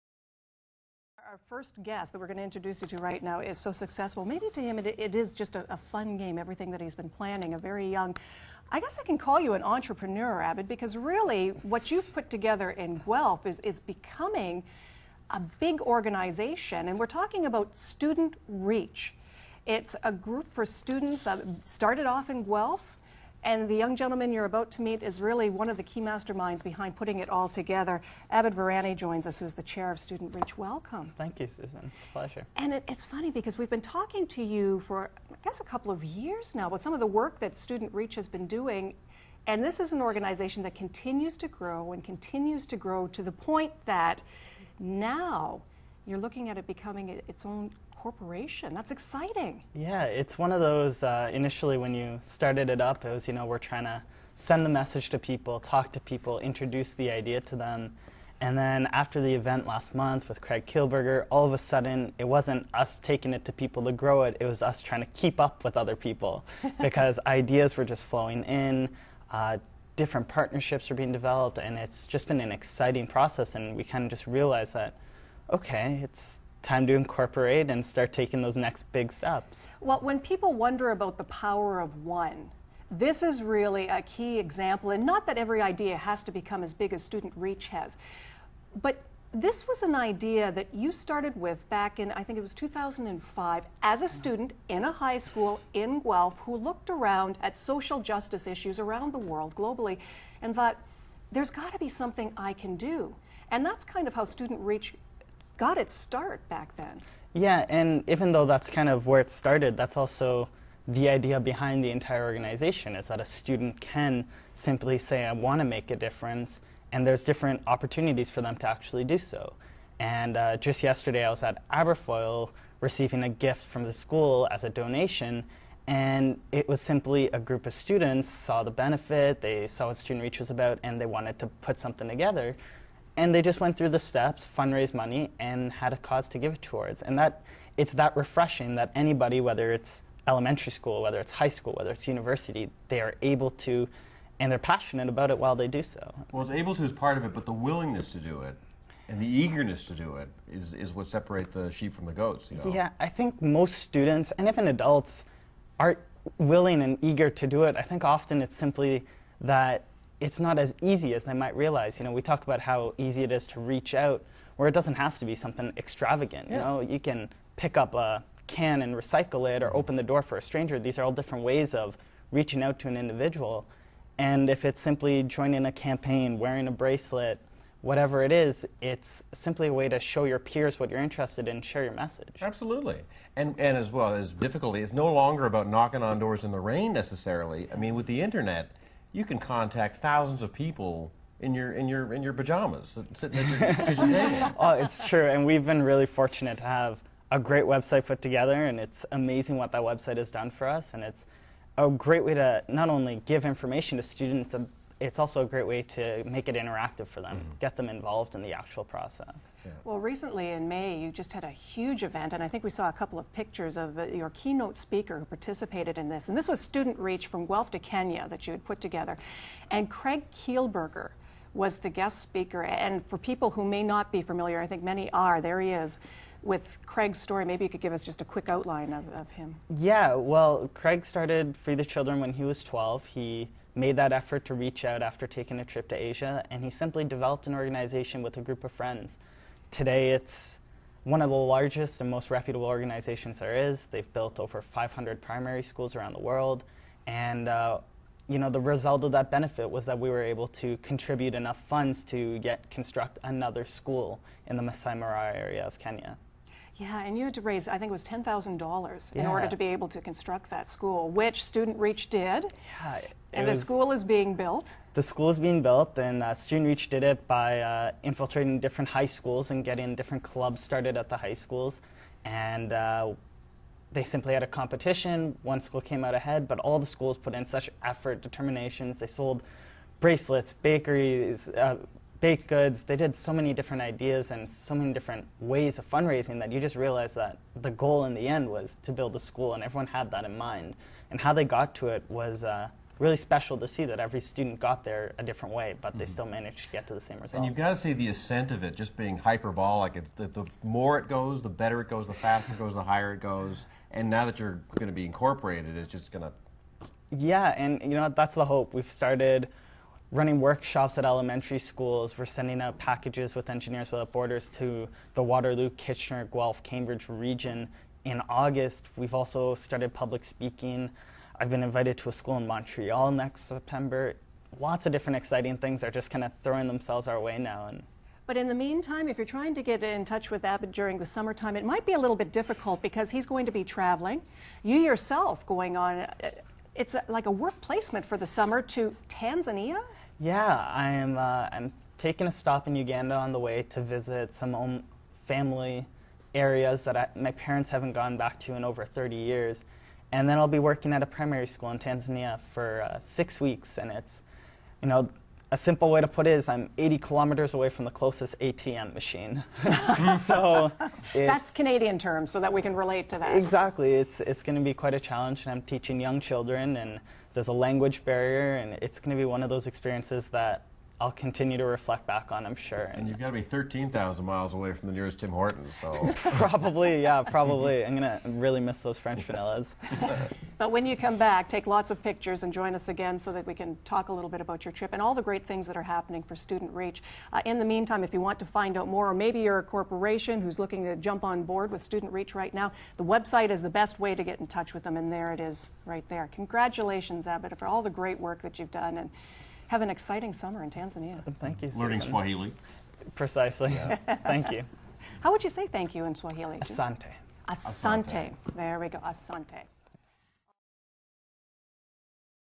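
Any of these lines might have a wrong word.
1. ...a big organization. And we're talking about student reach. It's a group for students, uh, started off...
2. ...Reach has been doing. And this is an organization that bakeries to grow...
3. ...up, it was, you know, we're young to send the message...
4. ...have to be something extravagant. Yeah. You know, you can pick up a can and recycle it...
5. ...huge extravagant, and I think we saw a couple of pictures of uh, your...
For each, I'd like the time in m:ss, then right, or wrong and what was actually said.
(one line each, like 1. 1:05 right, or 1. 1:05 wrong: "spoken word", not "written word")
1. 0:15 right
2. 0:37 wrong: "continues", not "bakeries"
3. 0:52 wrong: "trying", not "young"
4. 2:44 right
5. 3:31 wrong: "event", not "extravagant".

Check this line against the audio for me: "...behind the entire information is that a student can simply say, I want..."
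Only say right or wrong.
wrong.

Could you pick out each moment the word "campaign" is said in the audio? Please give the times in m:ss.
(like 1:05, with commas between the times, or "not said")
2:55.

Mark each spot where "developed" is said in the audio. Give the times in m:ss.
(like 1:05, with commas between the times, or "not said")
1:11, 3:57.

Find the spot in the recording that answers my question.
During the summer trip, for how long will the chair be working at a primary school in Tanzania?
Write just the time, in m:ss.
5:52.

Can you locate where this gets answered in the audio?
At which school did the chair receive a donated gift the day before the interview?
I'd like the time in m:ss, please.
2:01.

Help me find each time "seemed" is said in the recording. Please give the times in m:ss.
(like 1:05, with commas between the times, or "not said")
not said.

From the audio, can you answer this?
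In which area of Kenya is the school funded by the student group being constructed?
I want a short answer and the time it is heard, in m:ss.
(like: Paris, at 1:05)
Masai Mara, at 4:14.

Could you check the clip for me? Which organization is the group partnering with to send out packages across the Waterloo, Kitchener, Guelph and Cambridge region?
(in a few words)
Engineers Without Borders.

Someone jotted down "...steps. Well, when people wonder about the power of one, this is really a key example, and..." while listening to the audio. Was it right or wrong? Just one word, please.
right.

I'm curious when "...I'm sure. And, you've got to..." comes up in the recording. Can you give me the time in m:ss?
6:12.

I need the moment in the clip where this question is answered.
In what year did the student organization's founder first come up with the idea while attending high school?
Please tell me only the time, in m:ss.
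1:32.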